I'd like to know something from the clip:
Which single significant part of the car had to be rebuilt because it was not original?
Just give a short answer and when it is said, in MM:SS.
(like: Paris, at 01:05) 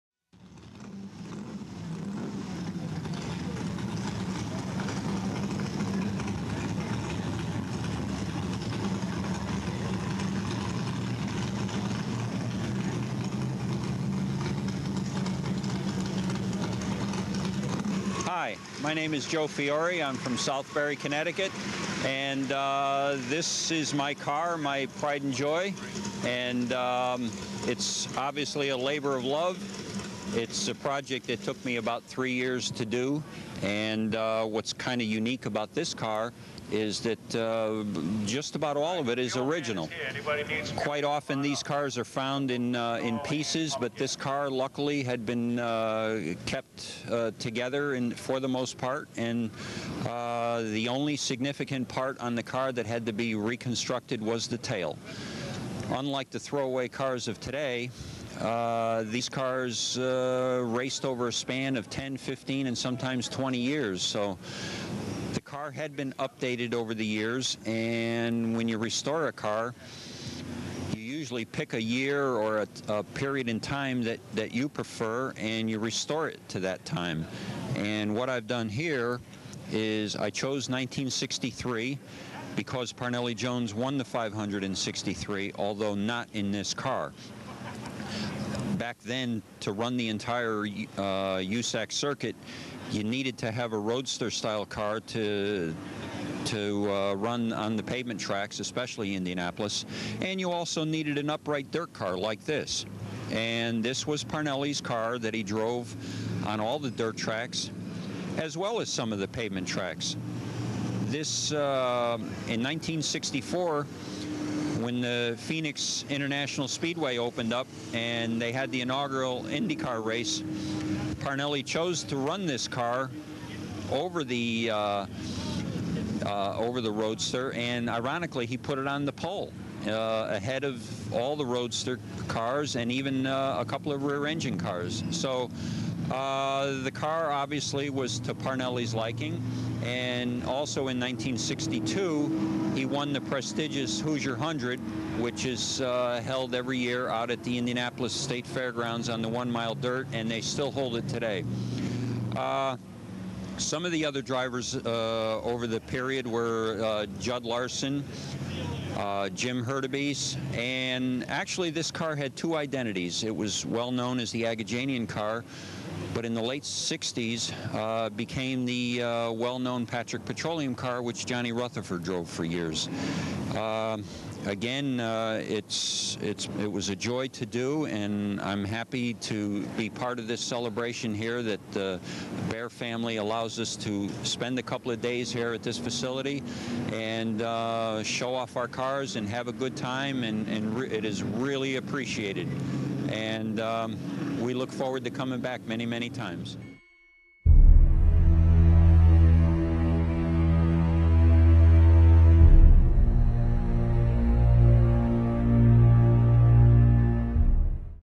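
The tail, at 00:54.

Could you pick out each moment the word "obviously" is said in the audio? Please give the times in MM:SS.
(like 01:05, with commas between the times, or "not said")
00:28, 02:17.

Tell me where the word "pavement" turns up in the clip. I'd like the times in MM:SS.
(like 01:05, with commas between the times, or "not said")
01:37, 01:49.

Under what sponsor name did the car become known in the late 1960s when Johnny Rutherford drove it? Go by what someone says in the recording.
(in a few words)
Patrick Petroleum.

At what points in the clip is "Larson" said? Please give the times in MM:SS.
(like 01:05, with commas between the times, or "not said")
02:37.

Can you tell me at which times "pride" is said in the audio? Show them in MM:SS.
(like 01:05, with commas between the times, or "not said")
00:24.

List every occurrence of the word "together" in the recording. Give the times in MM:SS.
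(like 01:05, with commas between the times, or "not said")
00:47.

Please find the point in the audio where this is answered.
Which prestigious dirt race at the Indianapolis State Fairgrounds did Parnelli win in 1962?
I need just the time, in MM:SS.
02:24.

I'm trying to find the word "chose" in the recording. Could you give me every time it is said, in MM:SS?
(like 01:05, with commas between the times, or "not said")
01:20, 02:01.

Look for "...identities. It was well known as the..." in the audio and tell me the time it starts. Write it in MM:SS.
02:42.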